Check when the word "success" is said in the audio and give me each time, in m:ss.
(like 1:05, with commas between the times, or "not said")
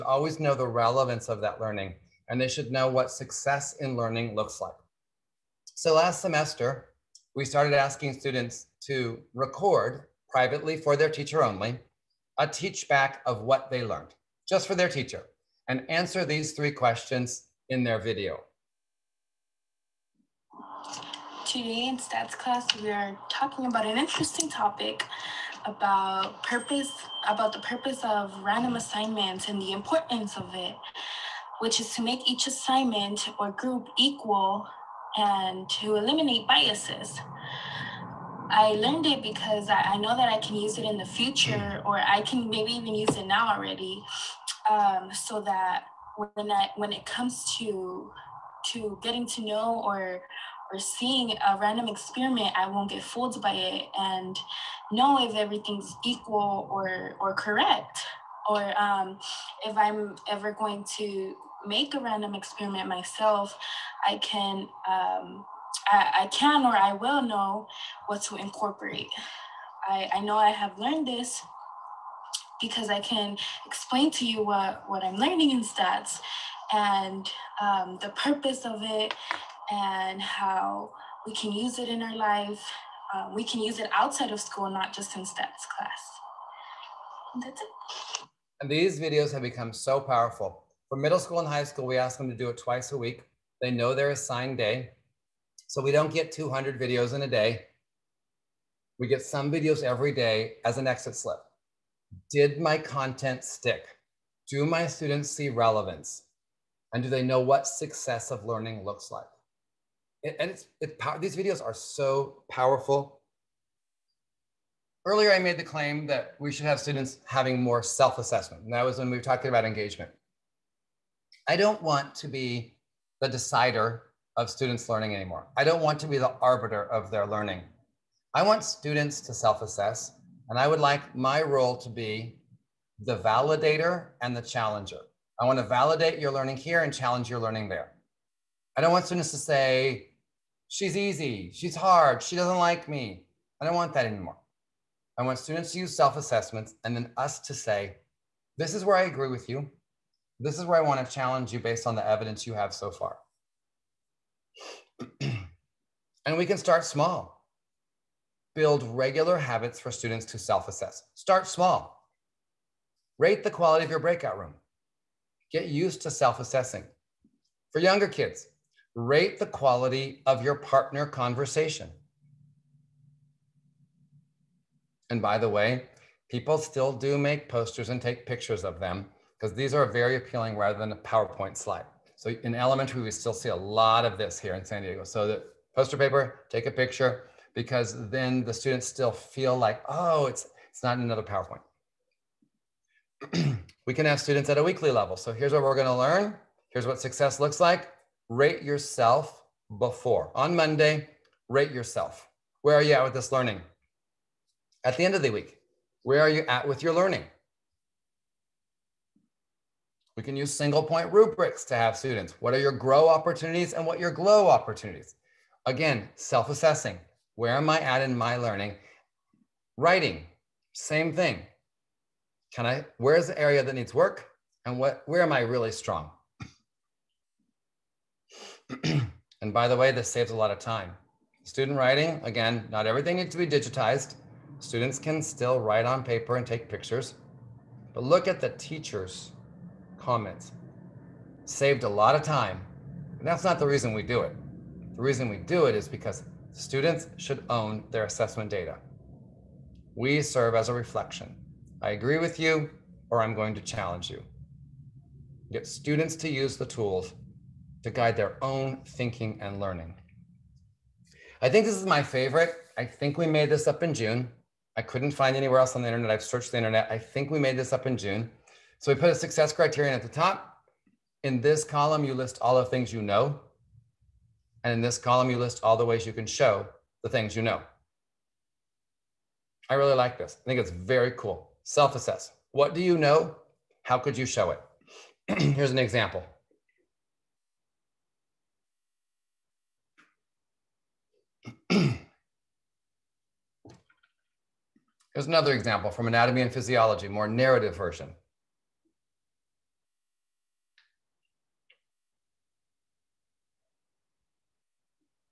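0:03, 1:47, 3:17, 4:29.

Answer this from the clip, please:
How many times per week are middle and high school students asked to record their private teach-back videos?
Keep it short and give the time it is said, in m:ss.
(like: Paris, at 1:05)
Twice a week, at 1:32.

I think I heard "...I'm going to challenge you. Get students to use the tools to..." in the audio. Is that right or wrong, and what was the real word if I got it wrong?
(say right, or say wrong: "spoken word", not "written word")
right.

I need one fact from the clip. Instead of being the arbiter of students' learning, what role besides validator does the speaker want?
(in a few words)
Challenger.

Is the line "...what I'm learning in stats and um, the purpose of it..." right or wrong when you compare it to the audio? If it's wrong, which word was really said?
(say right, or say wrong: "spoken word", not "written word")
right.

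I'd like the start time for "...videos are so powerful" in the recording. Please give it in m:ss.
1:51.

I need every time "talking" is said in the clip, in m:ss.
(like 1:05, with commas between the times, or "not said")
0:23, 1:59.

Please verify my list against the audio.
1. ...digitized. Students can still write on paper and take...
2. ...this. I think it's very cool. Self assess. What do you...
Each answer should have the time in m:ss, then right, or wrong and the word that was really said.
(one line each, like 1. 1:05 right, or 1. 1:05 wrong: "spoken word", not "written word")
1. 3:53 right
2. 4:40 right.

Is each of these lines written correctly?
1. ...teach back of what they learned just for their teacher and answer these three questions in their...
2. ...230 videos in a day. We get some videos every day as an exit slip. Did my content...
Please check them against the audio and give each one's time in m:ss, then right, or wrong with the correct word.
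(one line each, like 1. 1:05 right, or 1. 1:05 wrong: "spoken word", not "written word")
1. 0:12 right
2. 1:36 wrong: "200", not "230".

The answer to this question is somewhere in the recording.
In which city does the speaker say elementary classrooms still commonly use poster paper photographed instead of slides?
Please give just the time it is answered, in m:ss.
3:04.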